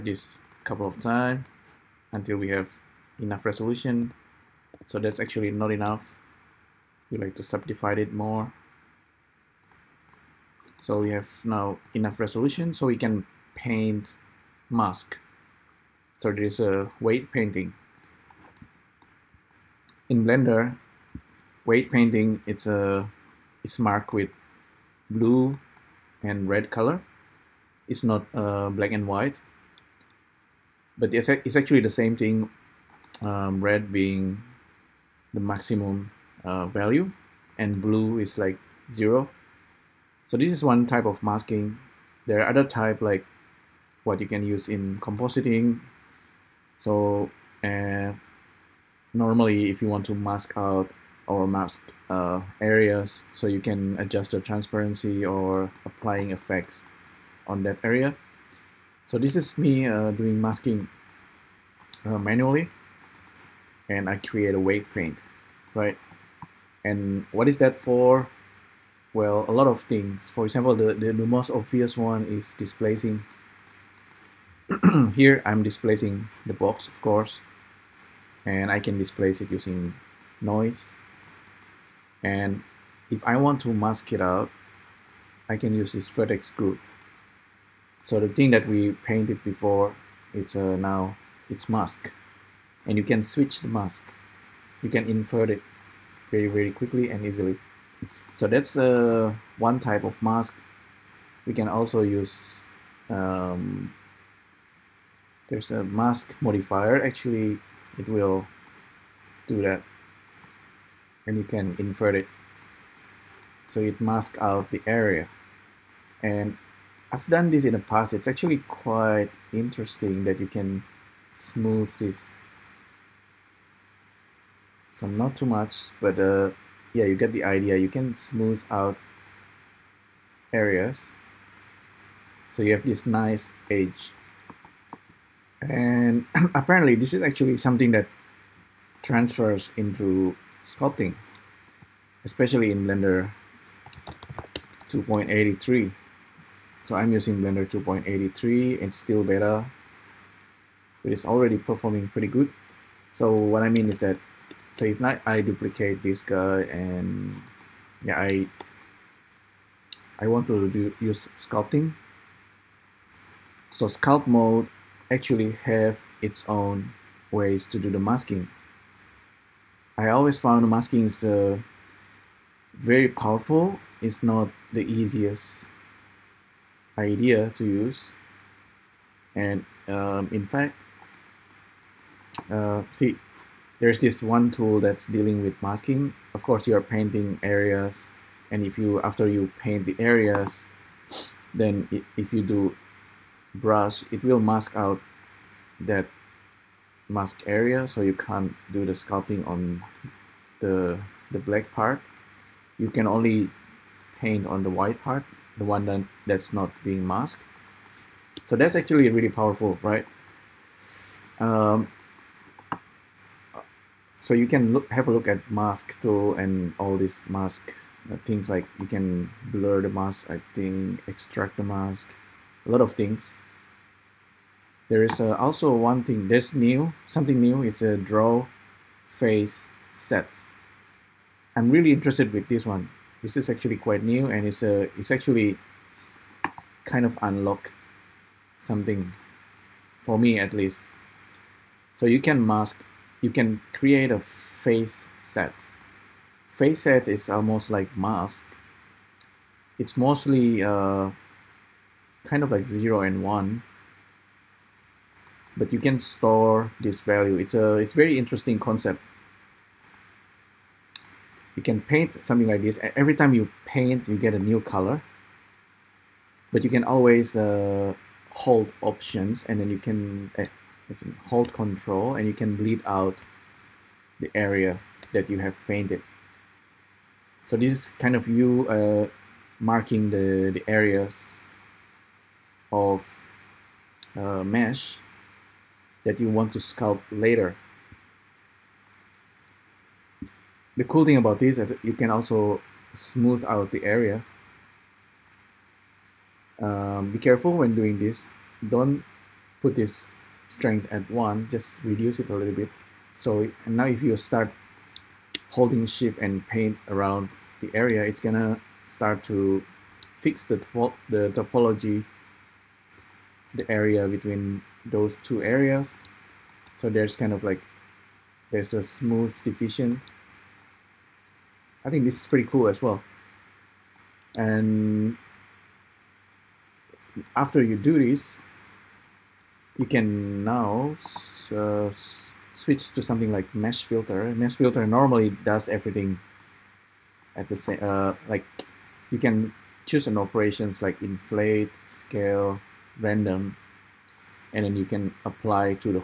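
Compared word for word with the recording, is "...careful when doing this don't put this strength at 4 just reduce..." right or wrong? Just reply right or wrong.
wrong.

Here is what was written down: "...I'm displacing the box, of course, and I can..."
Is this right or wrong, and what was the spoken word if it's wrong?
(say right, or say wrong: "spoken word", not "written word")
right.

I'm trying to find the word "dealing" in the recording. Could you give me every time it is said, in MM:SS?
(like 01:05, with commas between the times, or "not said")
03:05.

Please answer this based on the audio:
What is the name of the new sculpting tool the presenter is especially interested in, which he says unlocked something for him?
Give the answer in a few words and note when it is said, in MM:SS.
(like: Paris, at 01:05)
Draw face set, at 03:47.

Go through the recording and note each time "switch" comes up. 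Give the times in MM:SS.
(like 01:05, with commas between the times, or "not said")
01:33, 05:32.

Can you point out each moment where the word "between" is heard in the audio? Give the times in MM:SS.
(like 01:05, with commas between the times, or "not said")
05:14.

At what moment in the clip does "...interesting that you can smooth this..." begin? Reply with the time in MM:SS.
01:59.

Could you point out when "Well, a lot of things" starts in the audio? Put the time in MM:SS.
01:09.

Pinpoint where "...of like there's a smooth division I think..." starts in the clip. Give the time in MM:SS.
05:17.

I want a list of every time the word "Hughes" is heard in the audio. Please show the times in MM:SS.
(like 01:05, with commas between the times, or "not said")
not said.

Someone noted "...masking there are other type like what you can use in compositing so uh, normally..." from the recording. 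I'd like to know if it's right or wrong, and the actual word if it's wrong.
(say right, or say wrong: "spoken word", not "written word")
right.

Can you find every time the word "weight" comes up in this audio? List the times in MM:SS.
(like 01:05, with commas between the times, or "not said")
00:16, 00:21.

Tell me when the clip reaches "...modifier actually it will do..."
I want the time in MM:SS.
01:46.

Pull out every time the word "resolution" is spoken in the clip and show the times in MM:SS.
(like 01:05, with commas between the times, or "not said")
00:03, 00:12.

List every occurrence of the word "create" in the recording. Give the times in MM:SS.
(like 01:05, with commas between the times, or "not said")
01:04, 04:03.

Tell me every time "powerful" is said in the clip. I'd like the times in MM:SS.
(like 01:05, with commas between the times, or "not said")
02:53, 03:29.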